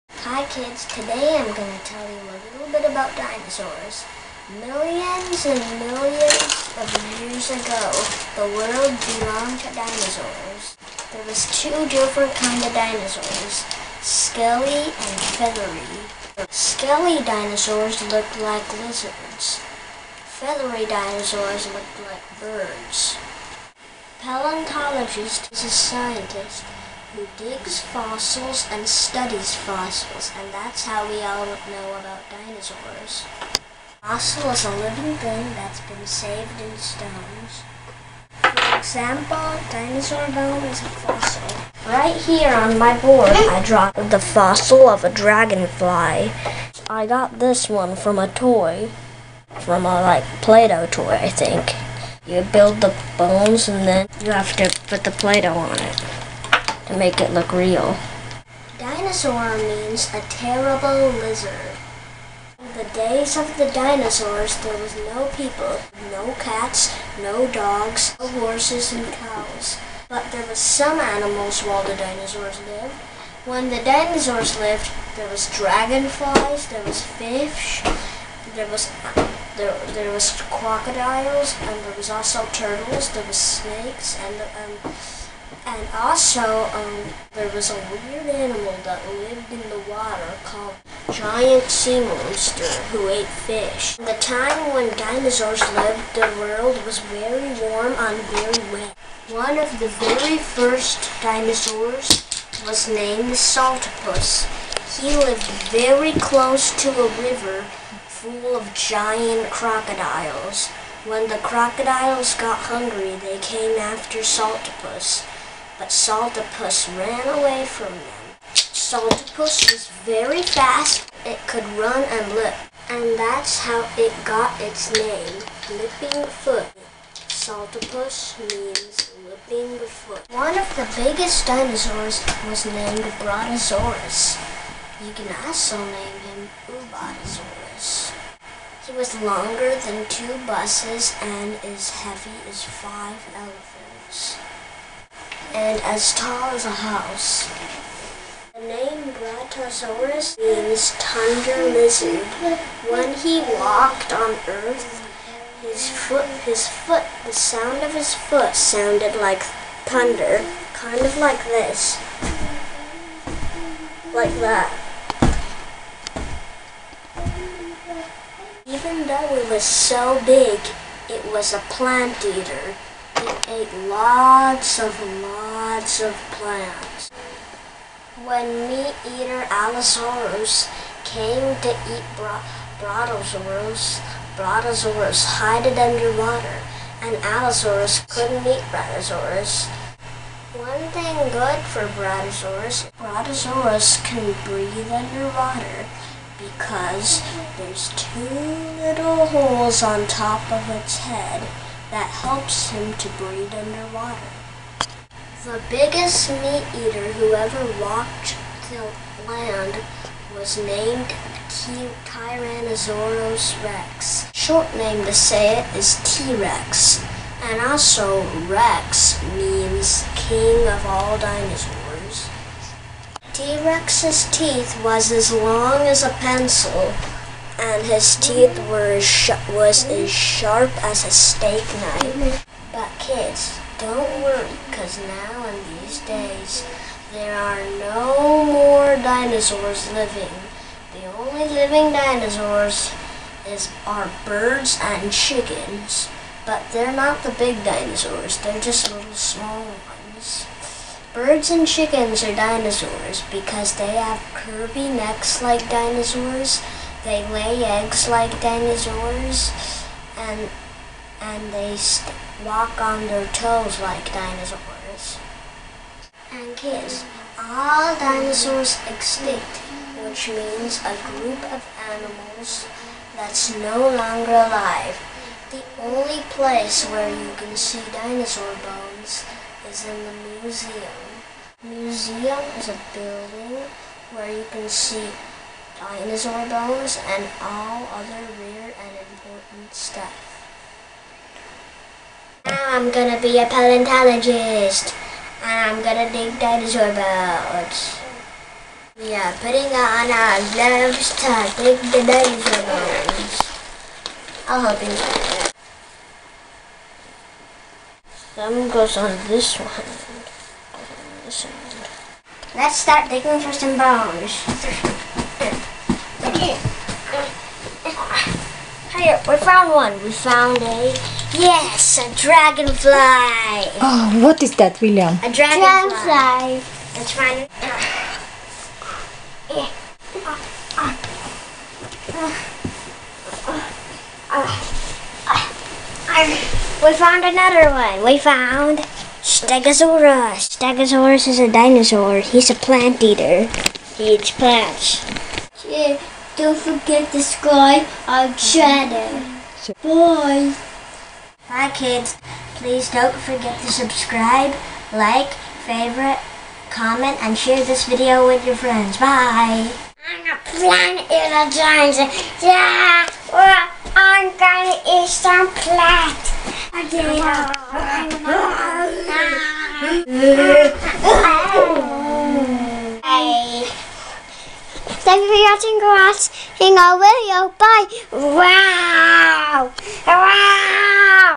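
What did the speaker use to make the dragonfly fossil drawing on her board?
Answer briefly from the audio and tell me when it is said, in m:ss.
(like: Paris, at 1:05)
Play-Doh toy, at 0:50.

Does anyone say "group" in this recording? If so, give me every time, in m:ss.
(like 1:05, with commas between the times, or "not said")
4:31.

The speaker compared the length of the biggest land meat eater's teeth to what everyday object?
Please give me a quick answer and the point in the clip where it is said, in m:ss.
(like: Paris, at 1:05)
A pencil, at 3:46.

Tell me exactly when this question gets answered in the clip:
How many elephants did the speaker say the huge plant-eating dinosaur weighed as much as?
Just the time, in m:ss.
2:22.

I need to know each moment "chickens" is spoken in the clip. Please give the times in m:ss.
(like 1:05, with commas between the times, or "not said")
4:05, 4:11.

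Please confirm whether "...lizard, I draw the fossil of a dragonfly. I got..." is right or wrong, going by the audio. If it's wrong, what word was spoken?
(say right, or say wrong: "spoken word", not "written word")
wrong: "board", not "lizard".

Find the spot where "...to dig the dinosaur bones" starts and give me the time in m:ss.
5:01.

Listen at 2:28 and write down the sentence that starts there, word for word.
The name Brachiosaurus means thunder lizard.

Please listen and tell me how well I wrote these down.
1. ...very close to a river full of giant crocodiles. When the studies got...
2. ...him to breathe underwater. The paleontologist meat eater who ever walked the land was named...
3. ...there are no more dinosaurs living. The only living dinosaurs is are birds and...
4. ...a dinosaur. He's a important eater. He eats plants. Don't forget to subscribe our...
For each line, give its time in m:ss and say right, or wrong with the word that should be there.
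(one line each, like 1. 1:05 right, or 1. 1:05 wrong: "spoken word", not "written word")
1. 1:45 wrong: "crocodiles", not "studies"
2. 3:22 wrong: "biggest", not "paleontologist"
3. 3:57 right
4. 5:41 wrong: "plant", not "important".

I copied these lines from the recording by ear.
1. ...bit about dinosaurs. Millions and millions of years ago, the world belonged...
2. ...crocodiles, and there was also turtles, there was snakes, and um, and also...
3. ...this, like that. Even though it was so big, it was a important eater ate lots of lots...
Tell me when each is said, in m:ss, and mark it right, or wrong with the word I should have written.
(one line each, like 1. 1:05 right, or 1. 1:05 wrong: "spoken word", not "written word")
1. 0:02 right
2. 1:20 right
3. 2:41 wrong: "plant", not "important".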